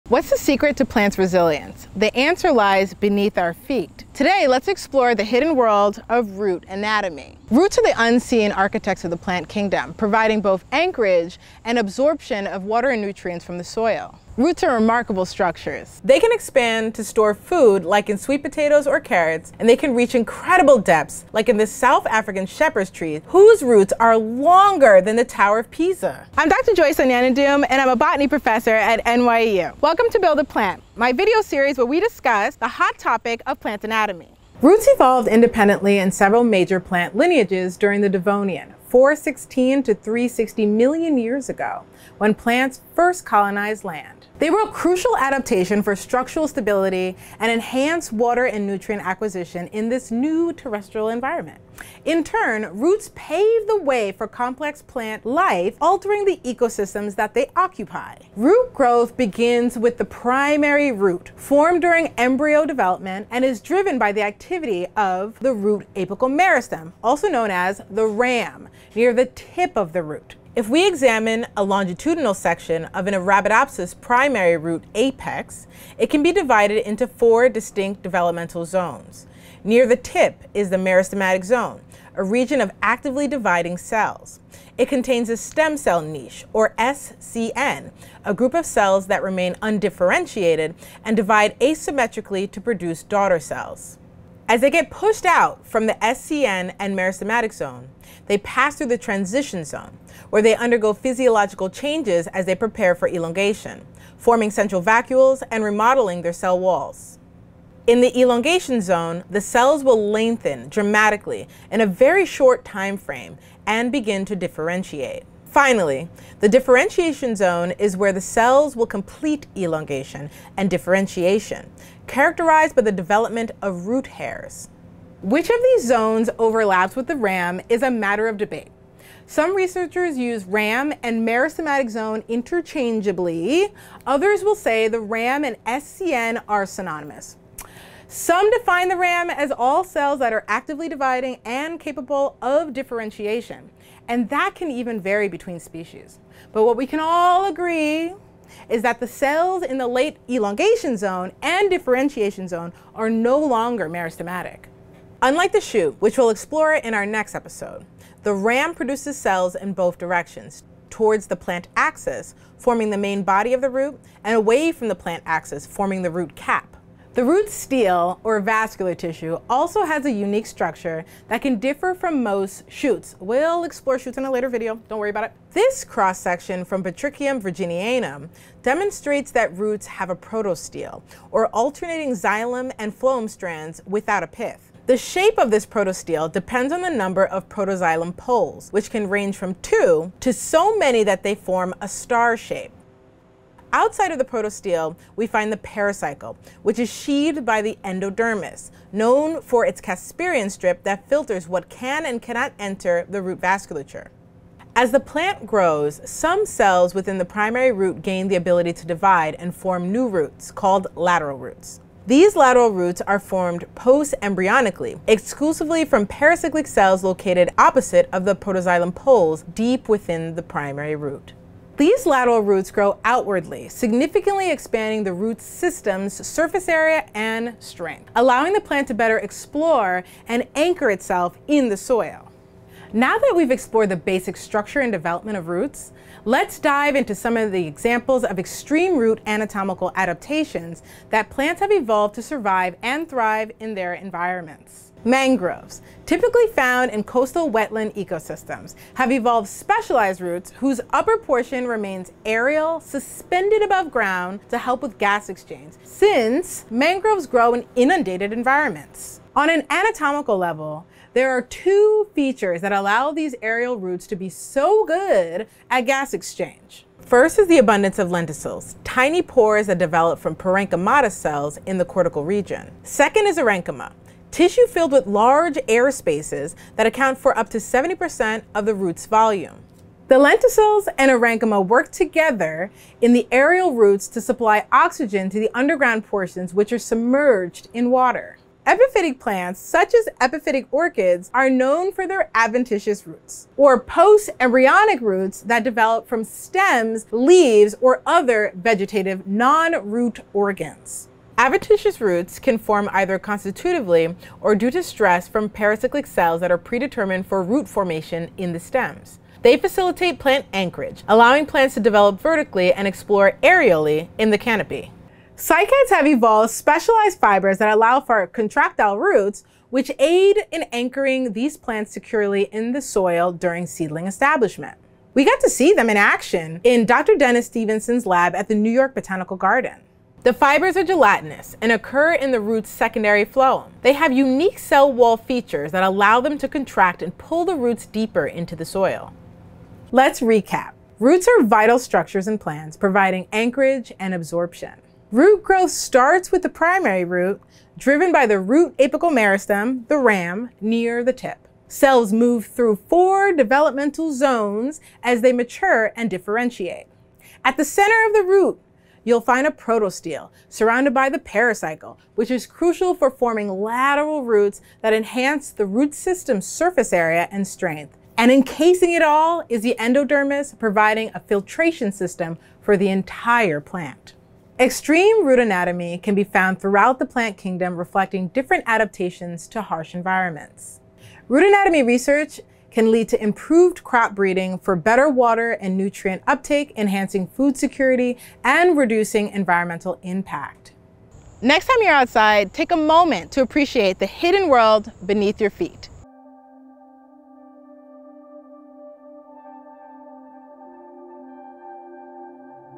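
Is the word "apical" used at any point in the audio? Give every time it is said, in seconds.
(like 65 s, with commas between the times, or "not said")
65 s, 348 s.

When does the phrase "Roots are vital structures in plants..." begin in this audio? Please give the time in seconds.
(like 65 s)
340 s.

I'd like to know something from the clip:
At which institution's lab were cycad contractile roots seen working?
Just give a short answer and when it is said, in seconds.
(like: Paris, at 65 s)
New York Botanical Garden, at 328 s.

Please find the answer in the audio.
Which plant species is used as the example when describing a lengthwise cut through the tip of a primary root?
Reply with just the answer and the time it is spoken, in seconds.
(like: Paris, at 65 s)
Arabidopsis, at 73 s.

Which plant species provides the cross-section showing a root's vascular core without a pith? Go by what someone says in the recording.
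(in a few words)
Botrychium virginianum.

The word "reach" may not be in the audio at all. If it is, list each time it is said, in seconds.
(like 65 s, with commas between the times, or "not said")
19 s.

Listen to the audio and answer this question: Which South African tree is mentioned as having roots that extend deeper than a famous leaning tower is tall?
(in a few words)
shepherd's tree.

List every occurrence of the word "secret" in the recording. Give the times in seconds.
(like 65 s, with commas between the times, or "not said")
0 s.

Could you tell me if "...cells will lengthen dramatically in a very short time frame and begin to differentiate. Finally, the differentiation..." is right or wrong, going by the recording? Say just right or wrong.
right.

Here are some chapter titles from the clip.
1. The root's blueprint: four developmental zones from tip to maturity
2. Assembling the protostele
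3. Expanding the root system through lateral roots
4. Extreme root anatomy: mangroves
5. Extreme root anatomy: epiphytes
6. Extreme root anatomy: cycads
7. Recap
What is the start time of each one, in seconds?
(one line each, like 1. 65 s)
1. 66 s
2. 167 s
3. 204 s
4. 245 s
5. 288 s
6. 315 s
7. 340 s.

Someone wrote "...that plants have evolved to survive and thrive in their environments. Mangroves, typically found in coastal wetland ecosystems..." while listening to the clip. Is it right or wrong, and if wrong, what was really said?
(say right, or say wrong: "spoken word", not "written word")
right.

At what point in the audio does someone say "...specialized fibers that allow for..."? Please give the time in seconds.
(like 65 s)
316 s.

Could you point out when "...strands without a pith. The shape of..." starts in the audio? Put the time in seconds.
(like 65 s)
183 s.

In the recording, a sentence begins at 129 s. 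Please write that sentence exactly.
Some researchers use RAM and meristematic zone interchangeably.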